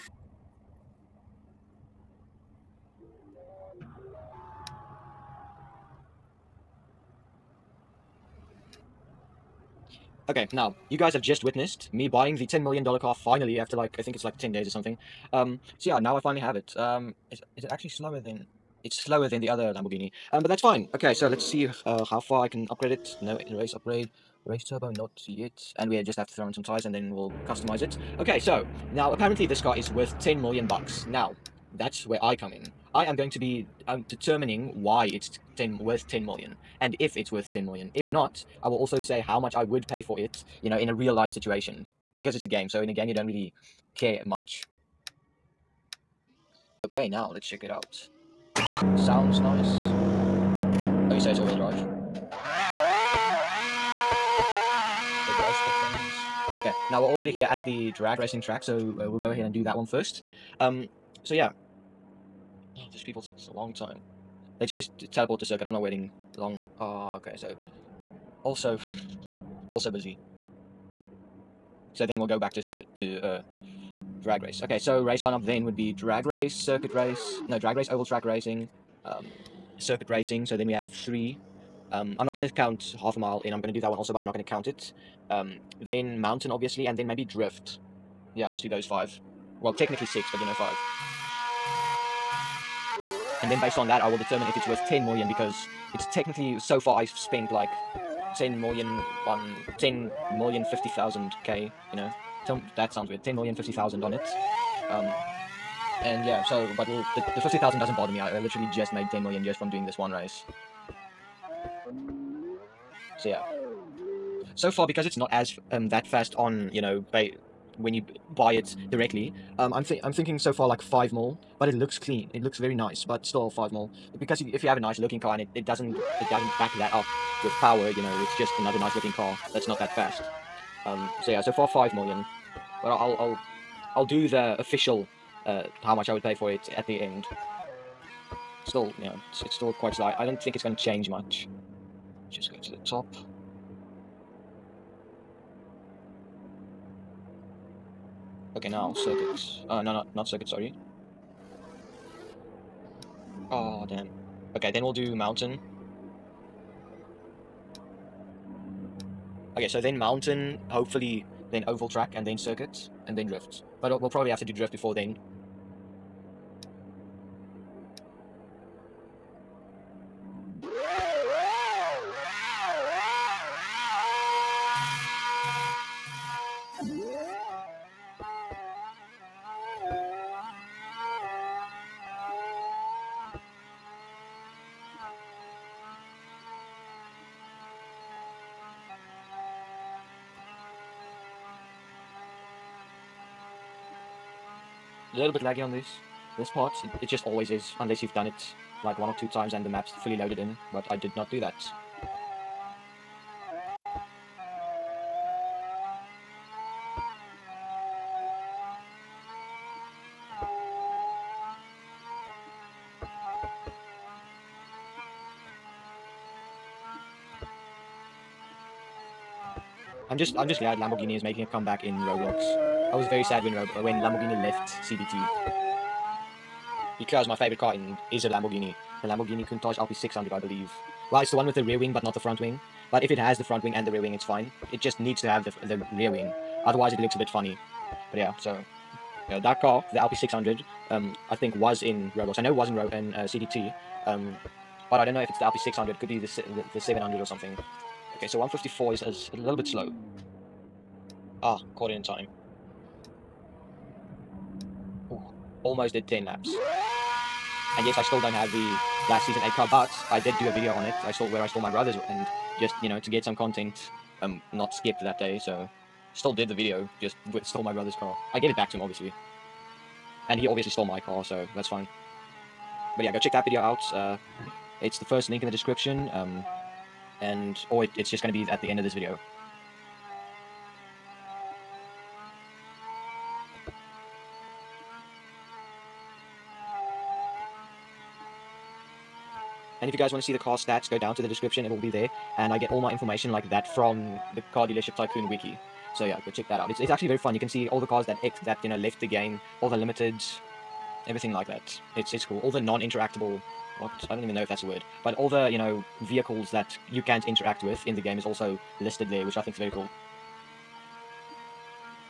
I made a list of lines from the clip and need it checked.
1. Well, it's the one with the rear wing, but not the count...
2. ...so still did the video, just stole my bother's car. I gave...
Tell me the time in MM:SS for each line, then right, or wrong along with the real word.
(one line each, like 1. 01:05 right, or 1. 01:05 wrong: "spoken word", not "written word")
1. 03:51 wrong: "front", not "count"
2. 04:25 wrong: "brother", not "bother".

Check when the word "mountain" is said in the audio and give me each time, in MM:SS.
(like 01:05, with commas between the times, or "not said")
01:26, 02:35, 02:39.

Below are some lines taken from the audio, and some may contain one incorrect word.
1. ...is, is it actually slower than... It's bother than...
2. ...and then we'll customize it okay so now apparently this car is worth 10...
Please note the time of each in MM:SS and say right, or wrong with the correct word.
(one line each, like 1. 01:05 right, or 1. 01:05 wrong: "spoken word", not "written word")
1. 00:17 wrong: "slower", not "bother"
2. 00:26 right.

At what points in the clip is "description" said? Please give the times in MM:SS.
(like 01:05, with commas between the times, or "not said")
04:35, 04:51.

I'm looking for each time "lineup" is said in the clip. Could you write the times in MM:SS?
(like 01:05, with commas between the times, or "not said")
01:15.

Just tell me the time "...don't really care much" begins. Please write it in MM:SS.
00:43.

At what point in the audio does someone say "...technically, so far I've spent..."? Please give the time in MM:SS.
01:36.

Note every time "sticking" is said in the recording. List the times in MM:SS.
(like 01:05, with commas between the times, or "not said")
not said.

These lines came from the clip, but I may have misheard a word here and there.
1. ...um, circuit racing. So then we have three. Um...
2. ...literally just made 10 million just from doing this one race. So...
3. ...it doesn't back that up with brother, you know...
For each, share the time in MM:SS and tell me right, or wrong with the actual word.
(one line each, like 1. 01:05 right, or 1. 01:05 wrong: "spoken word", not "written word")
1. 01:19 right
2. 01:48 right
3. 02:05 wrong: "power", not "brother".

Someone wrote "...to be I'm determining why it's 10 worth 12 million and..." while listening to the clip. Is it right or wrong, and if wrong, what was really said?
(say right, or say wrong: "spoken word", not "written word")
wrong: "10", not "12".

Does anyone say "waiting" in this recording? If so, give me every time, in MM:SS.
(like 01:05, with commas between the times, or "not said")
01:05.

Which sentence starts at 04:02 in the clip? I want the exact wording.
I know was in Ro in uh, CDT, um, but I don't know if it's the LP600.